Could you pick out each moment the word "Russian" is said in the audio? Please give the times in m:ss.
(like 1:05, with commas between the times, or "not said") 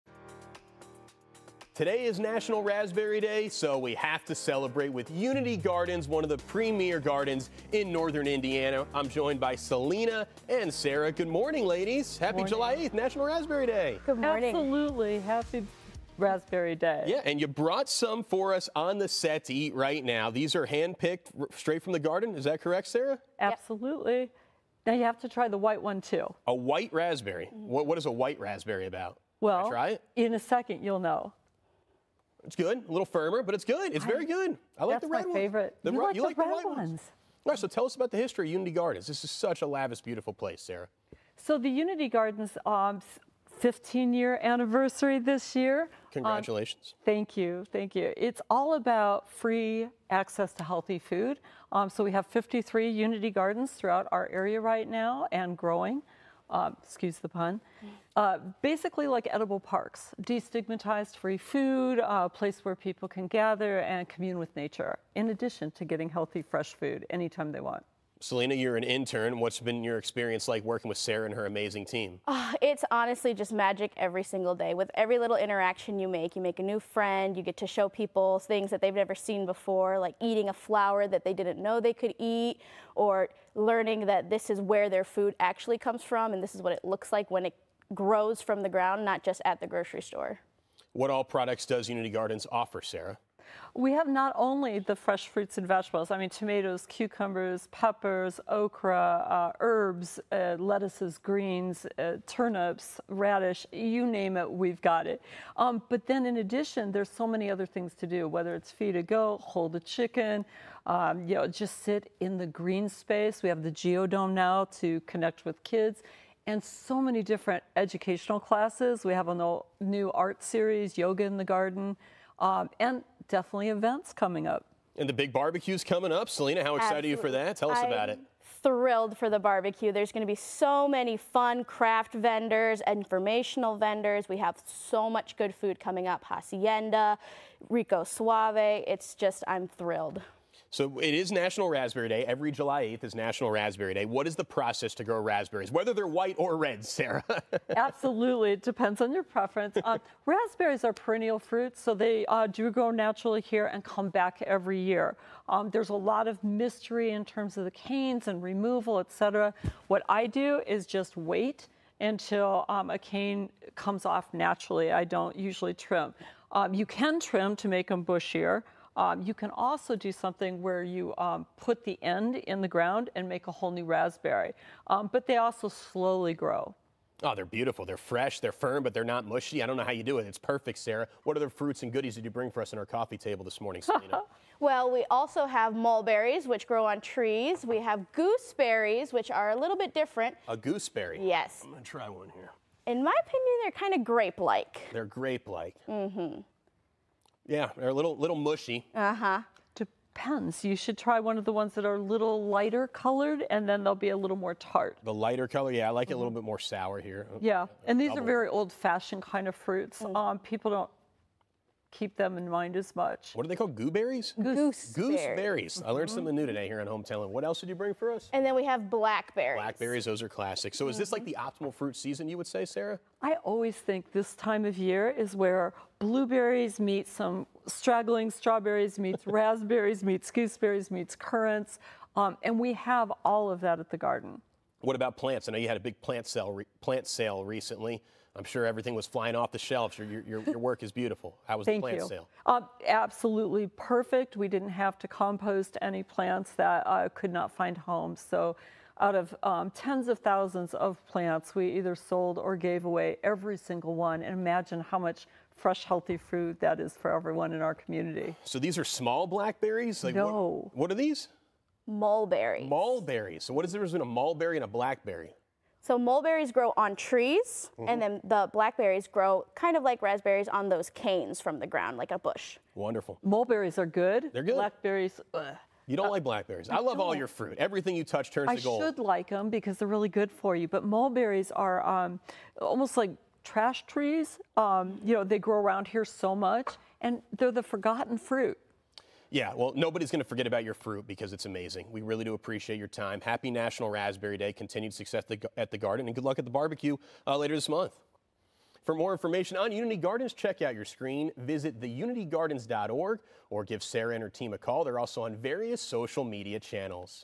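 not said.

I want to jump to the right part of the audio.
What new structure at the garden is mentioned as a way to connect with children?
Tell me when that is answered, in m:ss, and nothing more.
1:53.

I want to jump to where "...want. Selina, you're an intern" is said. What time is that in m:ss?
1:07.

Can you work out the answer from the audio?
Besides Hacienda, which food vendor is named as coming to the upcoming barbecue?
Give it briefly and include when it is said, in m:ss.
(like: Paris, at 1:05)
Rico Suave, at 2:17.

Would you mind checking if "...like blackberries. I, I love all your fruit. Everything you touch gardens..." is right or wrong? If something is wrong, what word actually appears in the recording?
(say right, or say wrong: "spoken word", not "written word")
wrong: "turns", not "gardens".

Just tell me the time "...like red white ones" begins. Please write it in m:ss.
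0:36.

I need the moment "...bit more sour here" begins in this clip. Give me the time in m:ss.
3:26.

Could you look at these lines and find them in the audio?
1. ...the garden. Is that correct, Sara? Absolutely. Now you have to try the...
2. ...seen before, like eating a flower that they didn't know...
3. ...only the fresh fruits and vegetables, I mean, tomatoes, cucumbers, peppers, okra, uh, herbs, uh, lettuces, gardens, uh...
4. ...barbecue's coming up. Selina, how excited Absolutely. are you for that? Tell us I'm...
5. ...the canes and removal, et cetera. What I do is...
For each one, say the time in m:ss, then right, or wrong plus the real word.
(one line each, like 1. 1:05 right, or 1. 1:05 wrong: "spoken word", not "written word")
1. 0:21 right
2. 1:19 right
3. 1:34 wrong: "greens", not "gardens"
4. 2:05 right
5. 2:37 right.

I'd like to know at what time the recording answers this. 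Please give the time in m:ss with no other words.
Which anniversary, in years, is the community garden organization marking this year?
0:43.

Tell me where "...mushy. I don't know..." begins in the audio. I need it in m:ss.
2:59.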